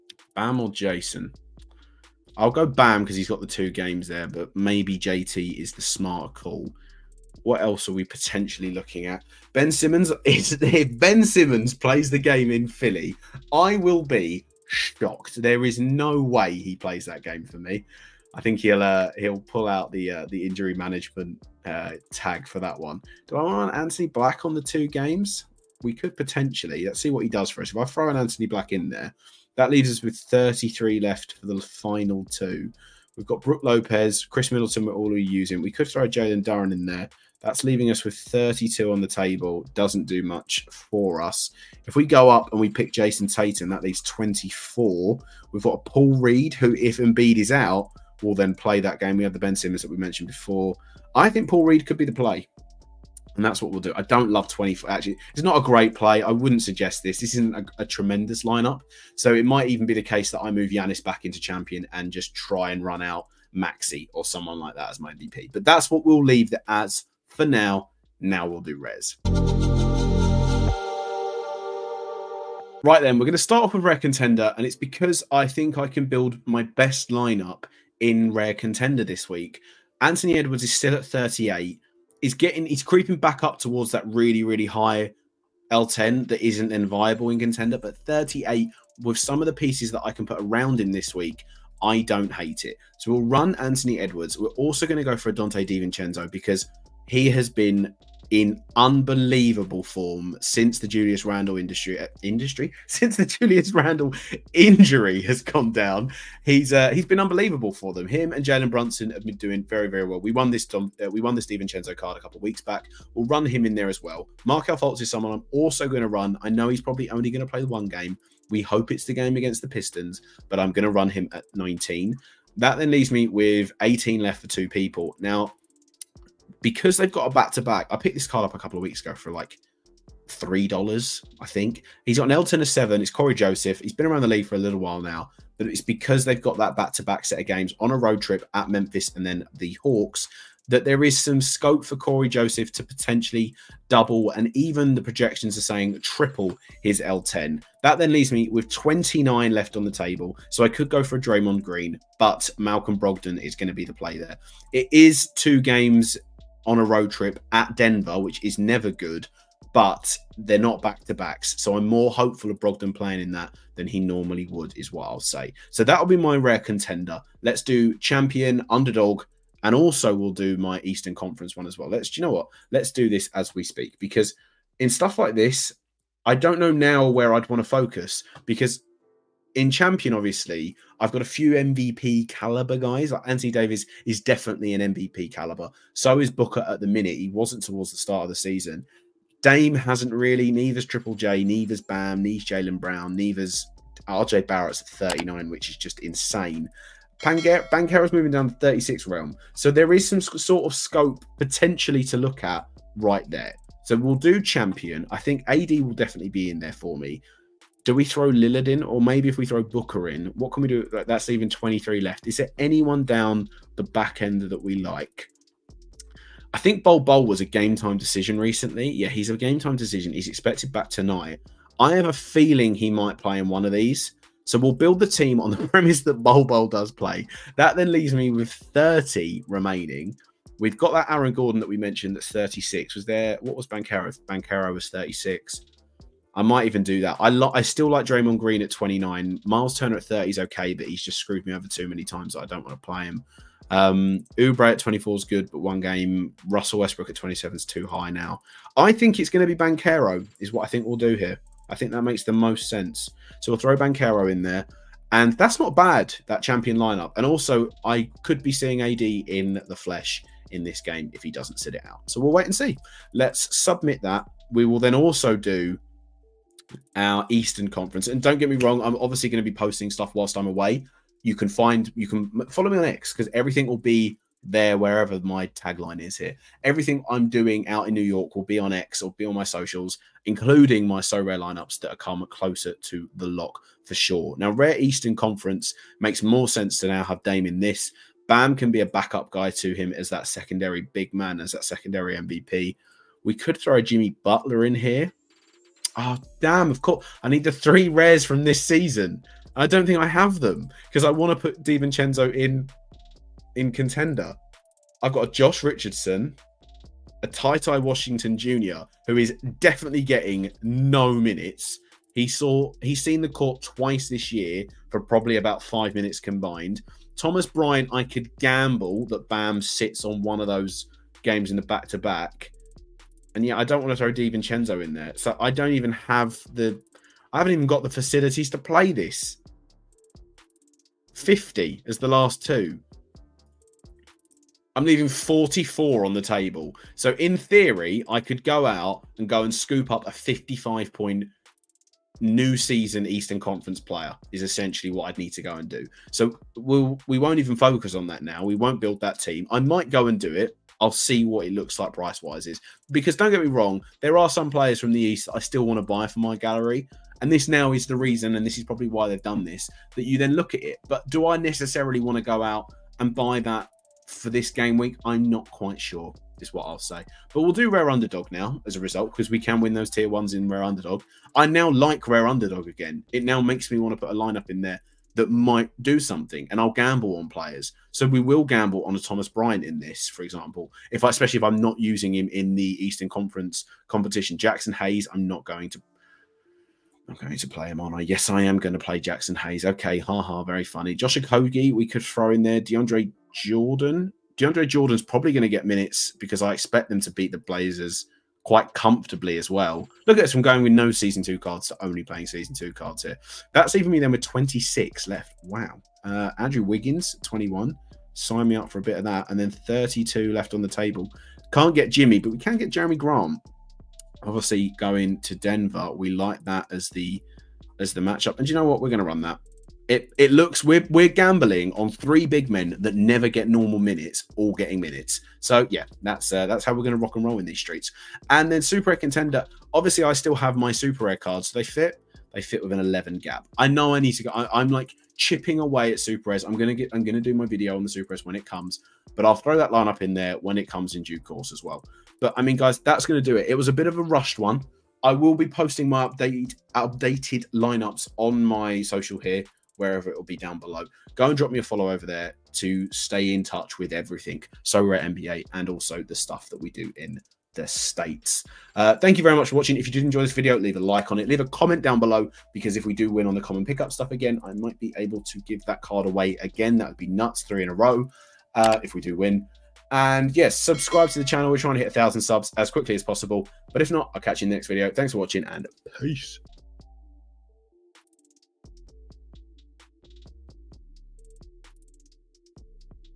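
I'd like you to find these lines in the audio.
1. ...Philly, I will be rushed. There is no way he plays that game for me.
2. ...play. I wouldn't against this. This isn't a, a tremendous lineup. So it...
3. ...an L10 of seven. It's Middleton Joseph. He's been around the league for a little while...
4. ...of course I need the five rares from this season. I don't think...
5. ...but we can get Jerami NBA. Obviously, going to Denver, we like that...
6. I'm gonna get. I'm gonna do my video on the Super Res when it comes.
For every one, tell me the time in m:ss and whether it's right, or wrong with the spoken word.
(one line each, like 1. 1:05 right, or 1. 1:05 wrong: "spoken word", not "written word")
1. 0:12 wrong: "shocked", not "rushed"
2. 0:55 wrong: "suggest", not "against"
3. 2:12 wrong: "Cory", not "Middleton"
4. 4:56 wrong: "three", not "five"
5. 6:52 wrong: "Grant", not "NBA"
6. 7:16 right.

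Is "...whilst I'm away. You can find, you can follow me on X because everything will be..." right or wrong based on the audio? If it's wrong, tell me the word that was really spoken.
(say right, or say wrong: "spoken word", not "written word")
right.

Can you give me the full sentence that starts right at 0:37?
That's leaving us with 32 on the table.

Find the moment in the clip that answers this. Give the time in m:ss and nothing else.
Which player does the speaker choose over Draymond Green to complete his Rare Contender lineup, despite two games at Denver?
2:32.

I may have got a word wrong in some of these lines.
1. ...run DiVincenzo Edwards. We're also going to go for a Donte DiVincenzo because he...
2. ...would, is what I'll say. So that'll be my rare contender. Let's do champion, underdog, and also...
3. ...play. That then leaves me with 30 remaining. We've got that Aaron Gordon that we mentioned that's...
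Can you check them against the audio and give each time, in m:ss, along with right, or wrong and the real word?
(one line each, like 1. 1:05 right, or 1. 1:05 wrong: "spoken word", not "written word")
1. 1:33 wrong: "Anthony", not "DiVincenzo"
2. 2:44 right
3. 3:46 right.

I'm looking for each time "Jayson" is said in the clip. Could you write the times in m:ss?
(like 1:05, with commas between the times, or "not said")
0:00, 0:42.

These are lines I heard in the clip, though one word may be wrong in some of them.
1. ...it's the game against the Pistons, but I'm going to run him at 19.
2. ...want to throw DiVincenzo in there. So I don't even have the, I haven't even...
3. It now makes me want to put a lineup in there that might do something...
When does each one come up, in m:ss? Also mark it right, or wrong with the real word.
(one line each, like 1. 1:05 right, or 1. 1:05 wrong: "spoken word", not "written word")
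1. 1:58 right
2. 5:23 right
3. 6:13 right.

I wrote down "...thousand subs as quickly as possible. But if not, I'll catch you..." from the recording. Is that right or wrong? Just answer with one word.
right.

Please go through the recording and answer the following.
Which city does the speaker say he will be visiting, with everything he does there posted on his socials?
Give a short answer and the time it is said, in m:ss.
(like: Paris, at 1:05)
New York, at 4:37.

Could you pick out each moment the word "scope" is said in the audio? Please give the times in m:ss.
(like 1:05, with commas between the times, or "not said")
2:21, 3:20.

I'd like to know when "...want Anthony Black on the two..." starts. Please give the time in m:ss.
0:23.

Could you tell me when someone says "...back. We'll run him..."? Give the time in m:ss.
1:52.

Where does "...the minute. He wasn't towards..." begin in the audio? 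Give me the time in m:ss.
3:06.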